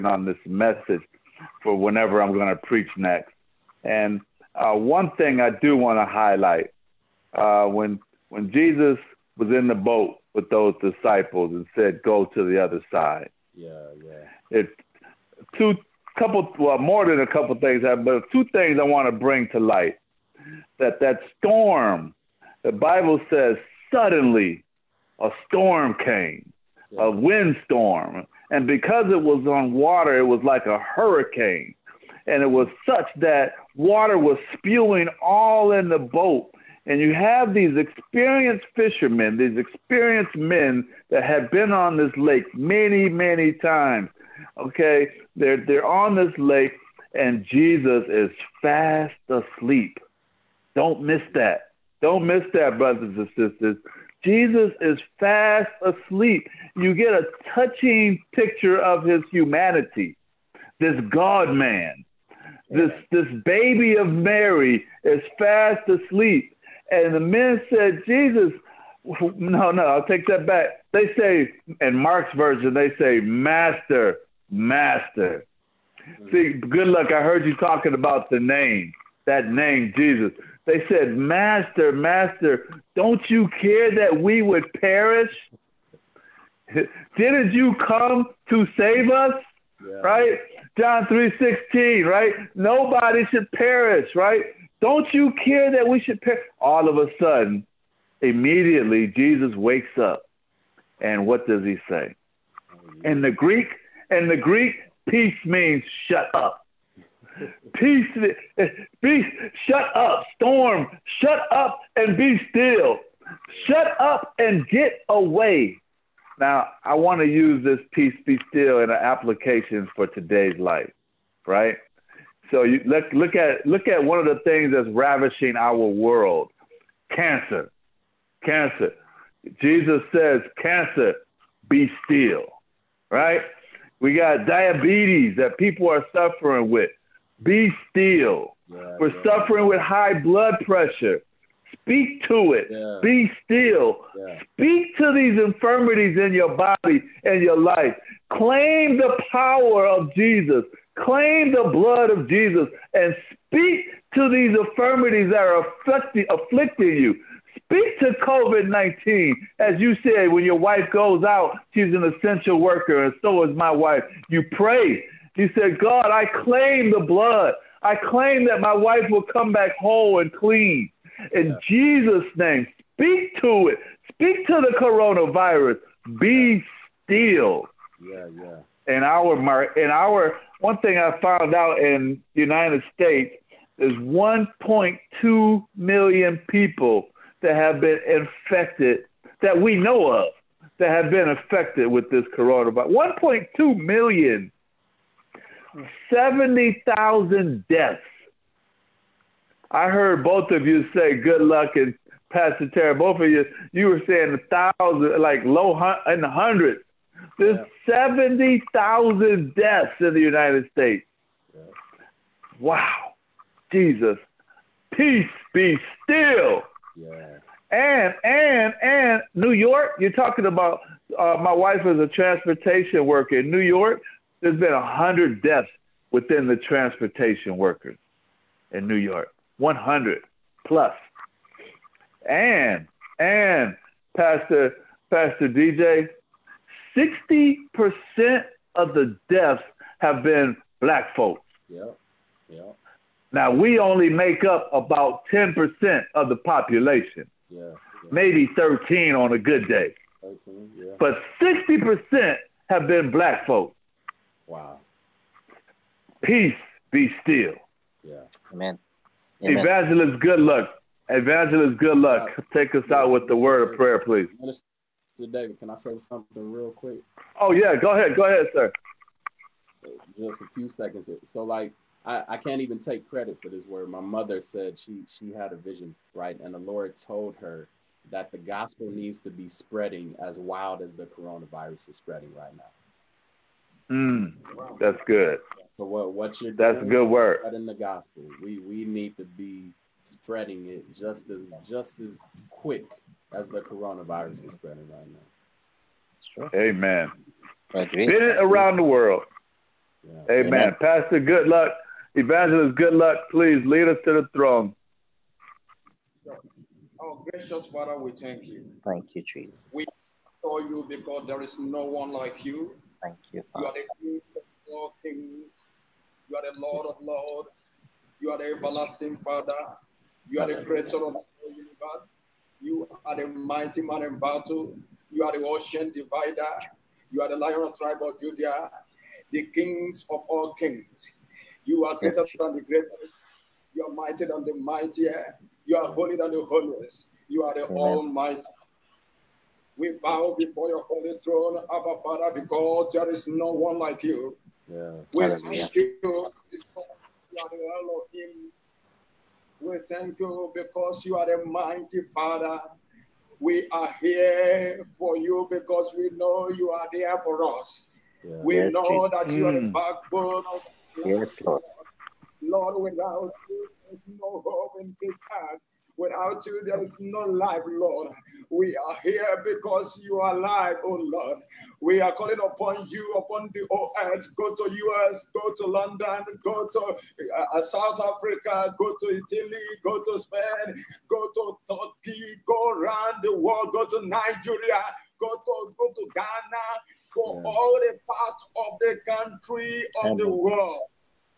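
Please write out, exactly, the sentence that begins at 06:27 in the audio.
all the parts of the country, of Amen.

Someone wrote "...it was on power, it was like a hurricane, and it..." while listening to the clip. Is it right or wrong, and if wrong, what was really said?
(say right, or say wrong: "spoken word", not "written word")
wrong: "water", not "power".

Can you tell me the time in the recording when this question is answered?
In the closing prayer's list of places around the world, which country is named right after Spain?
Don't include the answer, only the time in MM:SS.
06:21.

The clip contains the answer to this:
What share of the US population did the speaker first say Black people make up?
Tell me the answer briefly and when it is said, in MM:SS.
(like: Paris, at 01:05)
10%, at 04:05.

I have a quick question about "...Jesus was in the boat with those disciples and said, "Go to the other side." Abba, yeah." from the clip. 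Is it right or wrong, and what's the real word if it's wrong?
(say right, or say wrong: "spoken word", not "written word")
wrong: "Yeah", not "Abba".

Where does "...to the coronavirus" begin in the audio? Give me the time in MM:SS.
02:54.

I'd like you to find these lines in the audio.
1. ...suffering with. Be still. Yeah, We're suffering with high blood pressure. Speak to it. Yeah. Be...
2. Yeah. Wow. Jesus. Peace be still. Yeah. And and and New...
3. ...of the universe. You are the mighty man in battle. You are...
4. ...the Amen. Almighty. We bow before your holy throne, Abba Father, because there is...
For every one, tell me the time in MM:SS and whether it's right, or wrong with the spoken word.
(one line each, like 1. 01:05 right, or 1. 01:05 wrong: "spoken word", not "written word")
1. 02:16 right
2. 03:31 right
3. 05:21 right
4. 05:37 right.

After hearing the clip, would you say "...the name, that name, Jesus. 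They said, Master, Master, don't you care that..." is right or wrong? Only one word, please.
right.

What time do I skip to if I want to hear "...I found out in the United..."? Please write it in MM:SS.
03:00.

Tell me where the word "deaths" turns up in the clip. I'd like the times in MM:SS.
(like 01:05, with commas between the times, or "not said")
03:17, 03:29, 03:45, 03:59.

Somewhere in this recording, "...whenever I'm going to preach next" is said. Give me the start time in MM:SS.
00:01.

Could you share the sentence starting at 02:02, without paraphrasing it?
So you look, look at look at one of the things that's ravishing our world, cancer.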